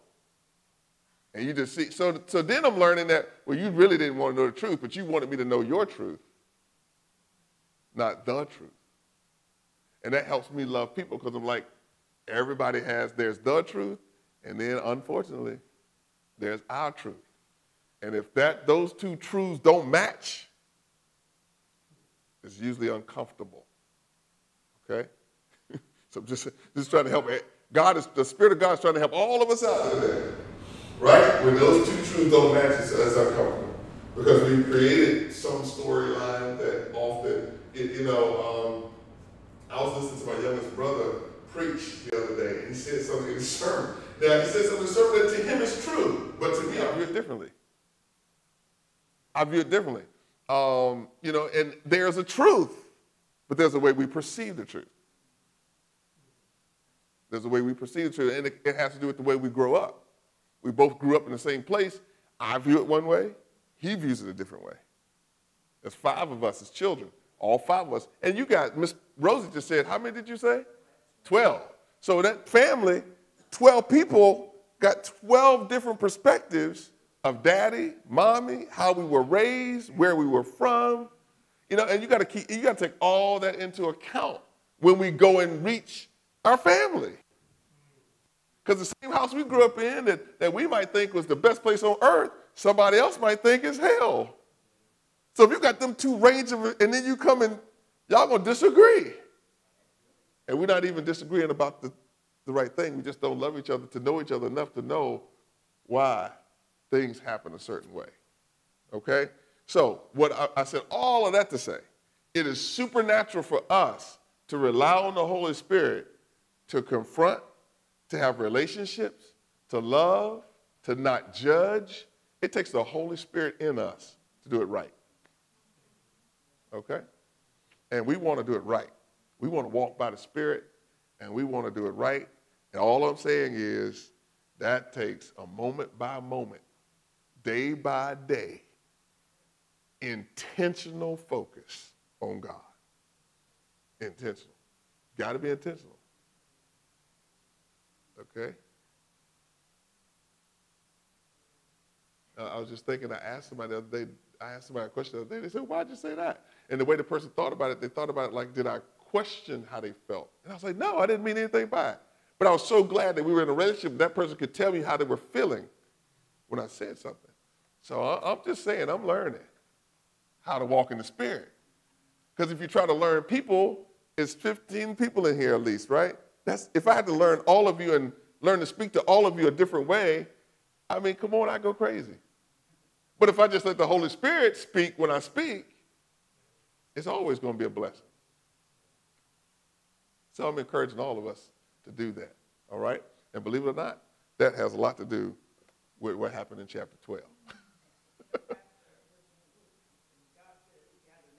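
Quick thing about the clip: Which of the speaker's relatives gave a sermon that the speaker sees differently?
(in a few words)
Youngest brother.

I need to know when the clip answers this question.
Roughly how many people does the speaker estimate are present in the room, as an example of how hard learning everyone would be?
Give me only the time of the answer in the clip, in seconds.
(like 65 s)
174 s.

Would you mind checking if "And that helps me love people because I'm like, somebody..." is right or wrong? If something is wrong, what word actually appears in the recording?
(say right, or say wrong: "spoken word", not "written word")
wrong: "everybody", not "somebody".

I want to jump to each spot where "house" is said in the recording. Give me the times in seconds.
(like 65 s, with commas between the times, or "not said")
89 s.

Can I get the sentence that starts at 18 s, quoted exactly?
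And if that those two truths don't match, it's usually uncomfortable.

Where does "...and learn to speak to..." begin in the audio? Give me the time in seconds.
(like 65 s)
177 s.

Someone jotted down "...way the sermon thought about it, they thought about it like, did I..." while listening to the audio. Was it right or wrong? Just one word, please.
wrong.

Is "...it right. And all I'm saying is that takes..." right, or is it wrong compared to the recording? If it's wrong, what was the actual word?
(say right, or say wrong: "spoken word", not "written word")
right.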